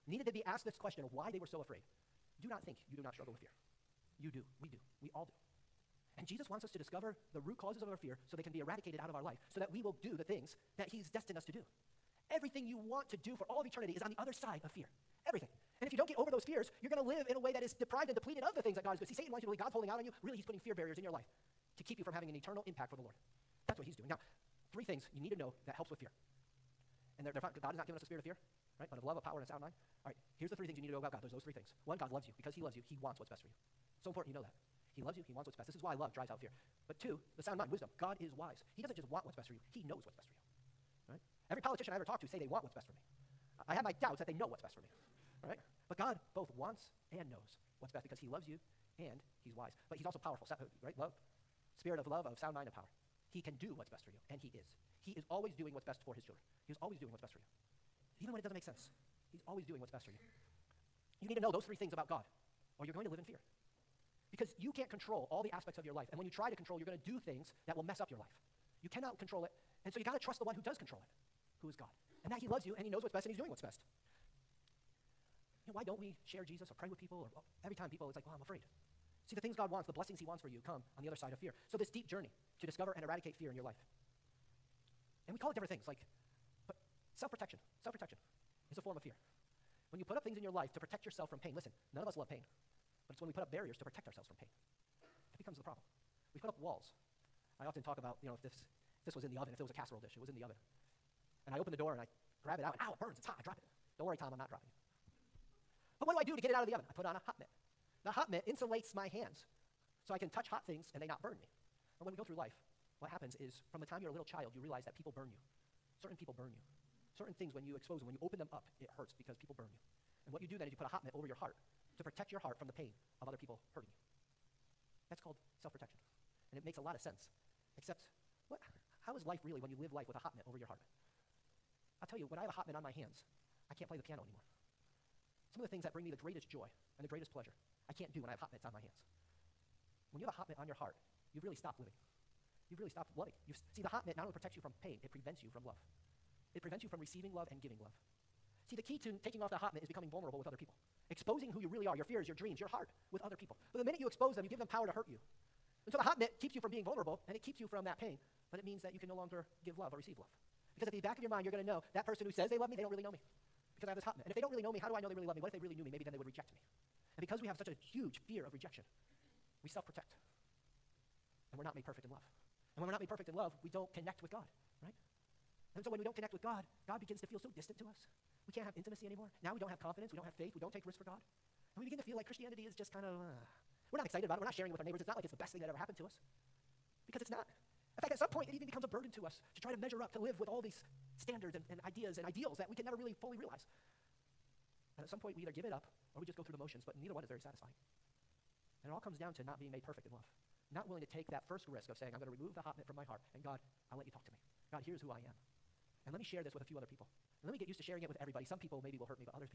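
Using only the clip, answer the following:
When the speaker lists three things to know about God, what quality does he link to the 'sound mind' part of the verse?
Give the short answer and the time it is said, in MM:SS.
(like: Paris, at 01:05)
Wisdom, at 00:37.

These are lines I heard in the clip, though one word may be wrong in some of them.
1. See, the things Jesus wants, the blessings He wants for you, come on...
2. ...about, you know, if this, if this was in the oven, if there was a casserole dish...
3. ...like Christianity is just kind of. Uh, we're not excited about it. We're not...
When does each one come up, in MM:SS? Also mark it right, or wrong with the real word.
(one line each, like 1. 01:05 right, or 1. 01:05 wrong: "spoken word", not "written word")
1. 01:19 wrong: "God", not "Jesus"
2. 01:37 right
3. 03:02 right.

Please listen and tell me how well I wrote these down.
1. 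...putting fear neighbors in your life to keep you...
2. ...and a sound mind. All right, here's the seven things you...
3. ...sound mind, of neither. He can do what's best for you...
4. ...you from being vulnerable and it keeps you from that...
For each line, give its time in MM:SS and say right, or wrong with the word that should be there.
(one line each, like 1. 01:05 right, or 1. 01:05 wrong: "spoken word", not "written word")
1. 00:20 wrong: "barriers", not "neighbors"
2. 00:29 wrong: "three", not "seven"
3. 00:52 wrong: "power", not "neither"
4. 02:36 right.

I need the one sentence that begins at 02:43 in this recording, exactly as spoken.
Because I have this hot mitt.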